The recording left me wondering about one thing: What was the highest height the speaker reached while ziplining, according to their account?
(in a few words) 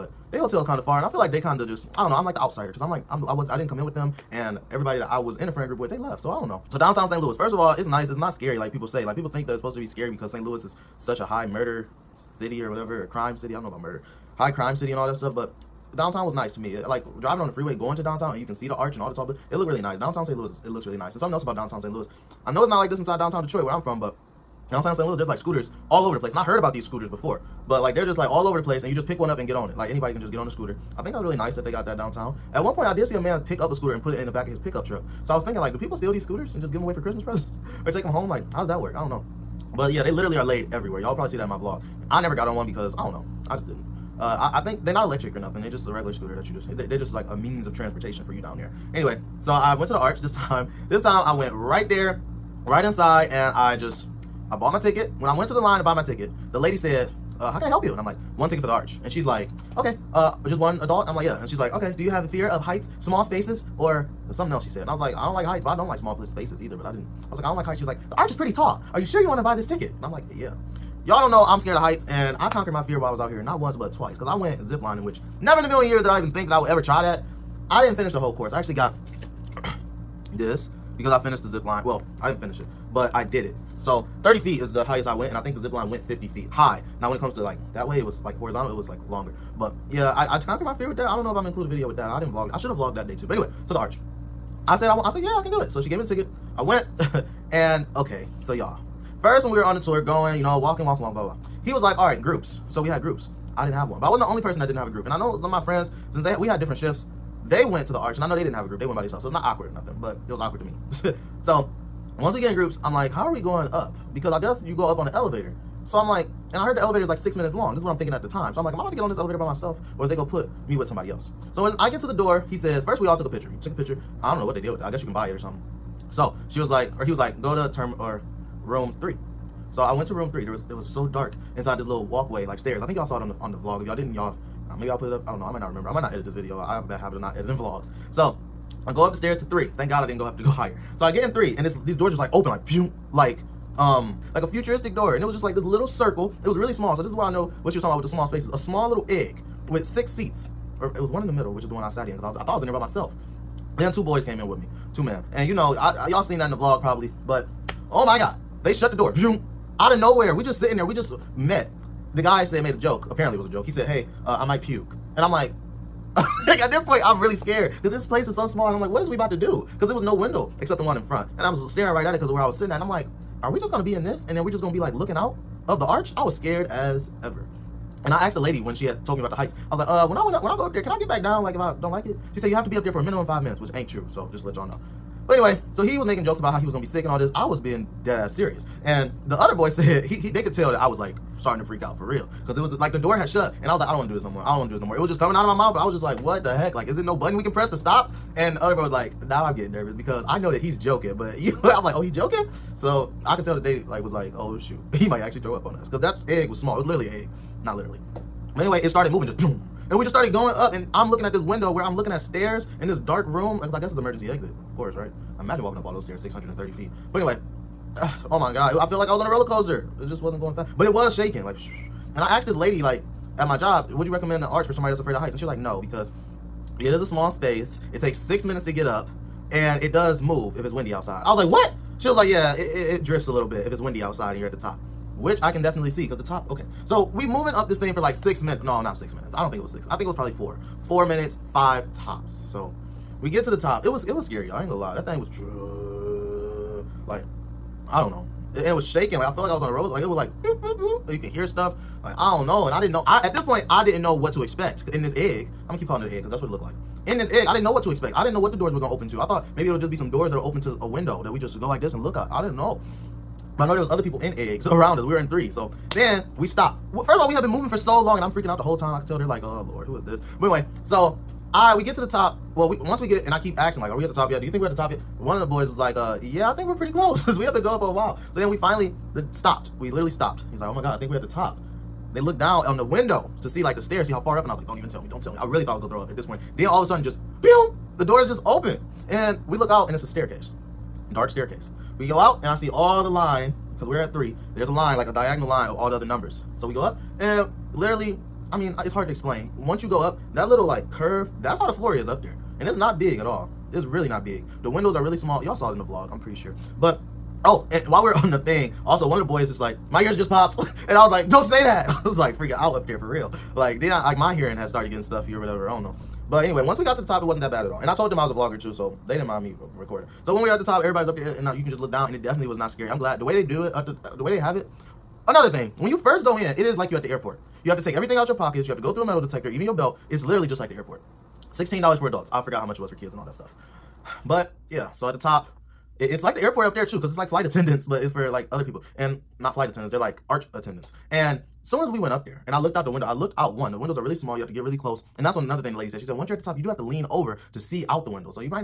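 30 feet.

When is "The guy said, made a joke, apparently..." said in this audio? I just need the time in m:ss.
2:42.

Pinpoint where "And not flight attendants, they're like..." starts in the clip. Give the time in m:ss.
5:38.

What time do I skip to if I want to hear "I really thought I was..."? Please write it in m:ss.
4:45.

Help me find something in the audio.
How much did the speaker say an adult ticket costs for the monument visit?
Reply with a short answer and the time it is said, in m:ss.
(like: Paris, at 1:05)
$16, at 5:31.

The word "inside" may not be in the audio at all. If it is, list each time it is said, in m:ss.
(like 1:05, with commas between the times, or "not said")
0:22, 0:52, 2:11.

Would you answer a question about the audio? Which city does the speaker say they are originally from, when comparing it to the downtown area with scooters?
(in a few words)
Detroit.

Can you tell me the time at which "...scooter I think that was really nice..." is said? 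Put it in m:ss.
0:30.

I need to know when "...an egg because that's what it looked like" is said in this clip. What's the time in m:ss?
4:16.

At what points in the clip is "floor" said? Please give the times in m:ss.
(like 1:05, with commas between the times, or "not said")
5:01.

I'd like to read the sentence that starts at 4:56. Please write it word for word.
So we go up and literally, I mean, it's hard to explain.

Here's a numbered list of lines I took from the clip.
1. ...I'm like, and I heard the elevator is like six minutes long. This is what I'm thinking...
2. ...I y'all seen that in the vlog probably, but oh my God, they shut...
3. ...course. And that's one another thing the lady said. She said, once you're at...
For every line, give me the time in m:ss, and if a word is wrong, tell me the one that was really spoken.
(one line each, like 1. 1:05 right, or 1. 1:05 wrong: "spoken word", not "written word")
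1. 1:55 right
2. 2:36 right
3. 5:44 wrong: "close", not "course".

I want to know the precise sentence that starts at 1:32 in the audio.
I didn't vlog I should have vlogged that day too.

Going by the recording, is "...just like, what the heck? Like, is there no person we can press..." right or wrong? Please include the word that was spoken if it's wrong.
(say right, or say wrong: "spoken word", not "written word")
wrong: "button", not "person".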